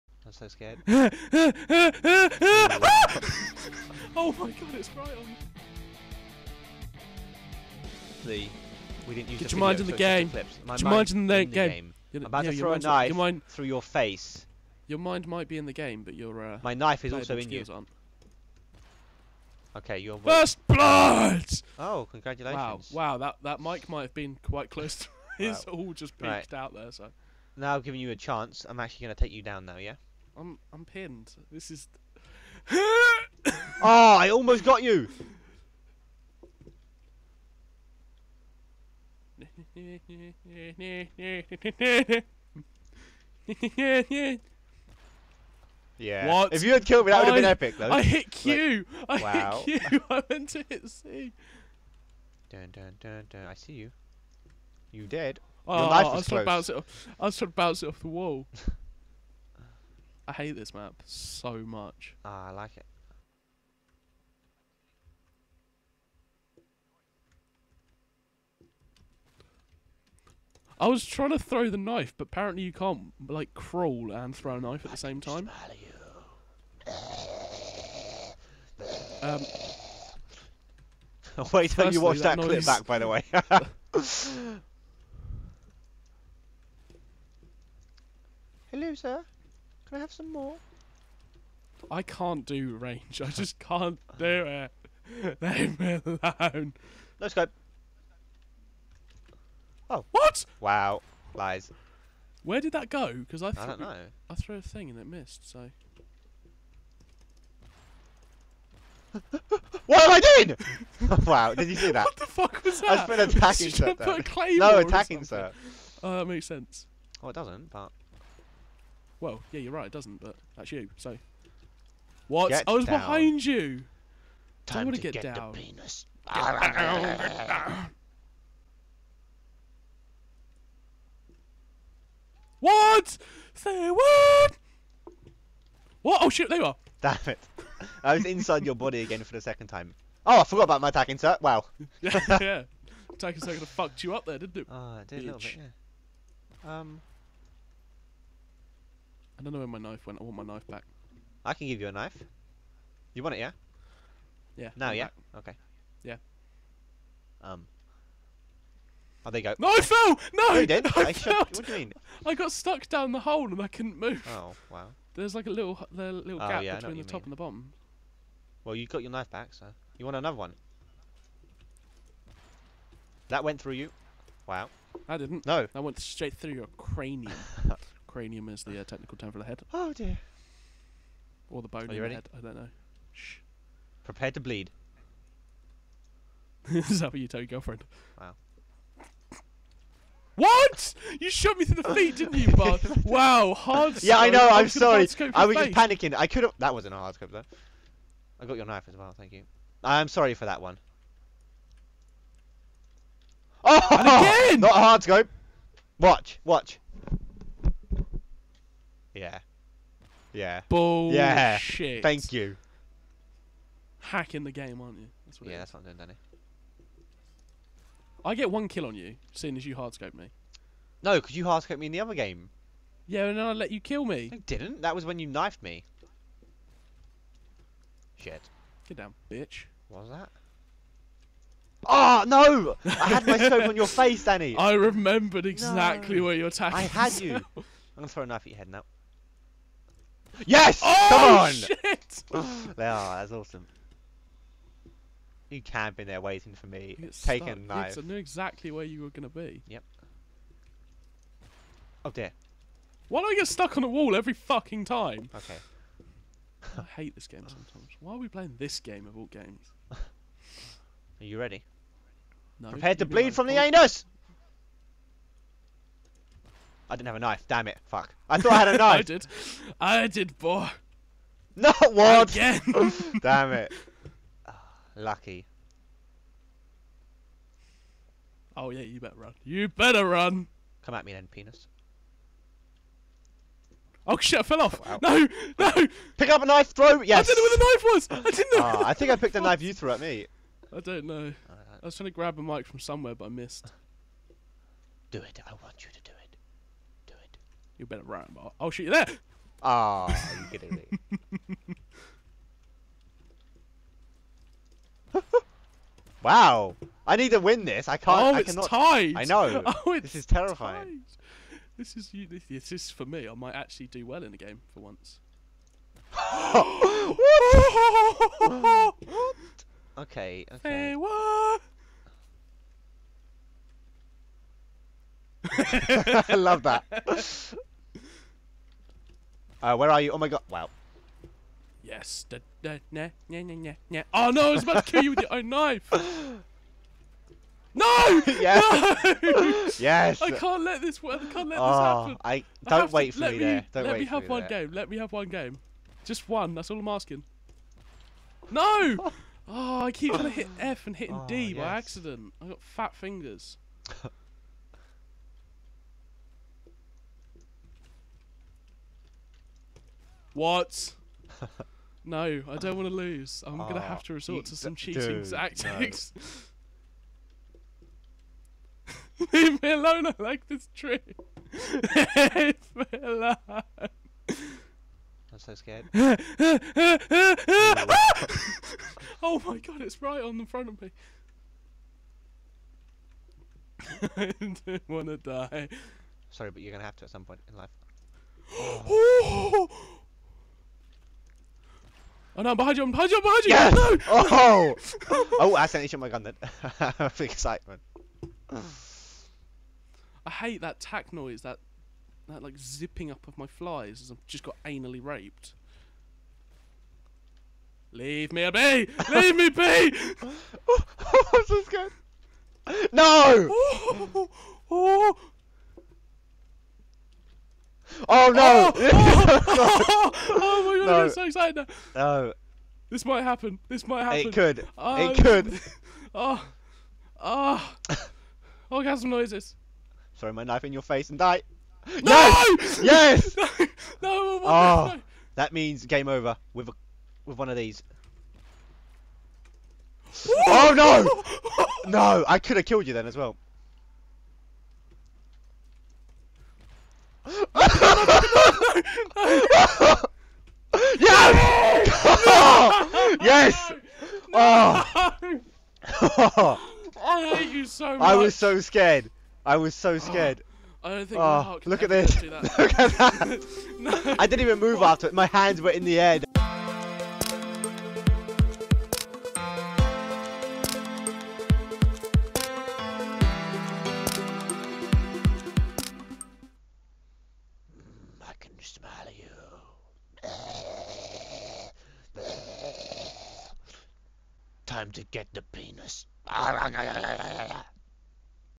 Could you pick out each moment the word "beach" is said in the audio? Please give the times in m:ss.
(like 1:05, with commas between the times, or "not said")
not said.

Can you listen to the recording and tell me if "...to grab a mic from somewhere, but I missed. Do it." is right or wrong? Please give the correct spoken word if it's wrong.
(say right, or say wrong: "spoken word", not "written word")
right.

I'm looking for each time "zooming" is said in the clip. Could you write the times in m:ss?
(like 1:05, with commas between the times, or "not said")
not said.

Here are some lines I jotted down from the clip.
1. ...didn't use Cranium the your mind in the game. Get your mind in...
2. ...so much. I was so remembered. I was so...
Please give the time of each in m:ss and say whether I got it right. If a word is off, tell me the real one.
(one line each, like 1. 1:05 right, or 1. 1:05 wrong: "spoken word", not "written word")
1. 0:09 wrong: "Get", not "Cranium"
2. 7:37 wrong: "scared", not "remembered".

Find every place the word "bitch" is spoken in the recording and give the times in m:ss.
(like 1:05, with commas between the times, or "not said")
2:25, 3:49.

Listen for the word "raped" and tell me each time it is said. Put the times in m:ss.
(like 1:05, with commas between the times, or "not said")
6:45.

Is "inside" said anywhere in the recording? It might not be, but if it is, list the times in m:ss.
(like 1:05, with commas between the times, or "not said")
2:18.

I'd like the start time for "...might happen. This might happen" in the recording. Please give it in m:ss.
7:03.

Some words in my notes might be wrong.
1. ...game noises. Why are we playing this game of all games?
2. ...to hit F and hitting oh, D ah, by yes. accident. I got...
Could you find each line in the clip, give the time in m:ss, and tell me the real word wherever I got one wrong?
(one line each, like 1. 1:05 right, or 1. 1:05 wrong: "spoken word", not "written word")
1. 4:17 wrong: "sometimes", not "noises"
2. 5:50 right.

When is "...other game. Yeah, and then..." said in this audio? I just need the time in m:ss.
3:41.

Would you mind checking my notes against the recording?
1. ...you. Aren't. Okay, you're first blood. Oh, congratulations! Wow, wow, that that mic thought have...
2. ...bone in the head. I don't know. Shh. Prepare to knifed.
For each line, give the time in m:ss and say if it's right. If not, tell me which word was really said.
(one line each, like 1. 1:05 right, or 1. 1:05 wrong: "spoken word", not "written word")
1. 0:17 wrong: "might", not "thought"
2. 3:01 wrong: "bleed", not "knifed".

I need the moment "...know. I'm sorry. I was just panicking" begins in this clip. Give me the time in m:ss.
3:14.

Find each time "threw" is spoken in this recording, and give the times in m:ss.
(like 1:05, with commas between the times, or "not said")
1:44, 4:49.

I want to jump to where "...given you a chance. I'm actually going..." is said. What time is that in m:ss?
0:27.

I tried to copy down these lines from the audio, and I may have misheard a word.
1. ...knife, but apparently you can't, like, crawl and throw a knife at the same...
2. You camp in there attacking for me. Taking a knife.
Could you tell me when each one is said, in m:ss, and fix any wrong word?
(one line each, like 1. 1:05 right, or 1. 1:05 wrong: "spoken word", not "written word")
1. 1:11 right
2. 4:05 wrong: "waiting", not "attacking".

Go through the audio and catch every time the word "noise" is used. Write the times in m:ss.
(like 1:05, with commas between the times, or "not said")
6:41, 7:09.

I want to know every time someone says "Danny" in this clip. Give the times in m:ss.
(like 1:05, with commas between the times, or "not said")
3:35, 3:54.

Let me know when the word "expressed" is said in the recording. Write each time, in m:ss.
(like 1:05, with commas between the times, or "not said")
not said.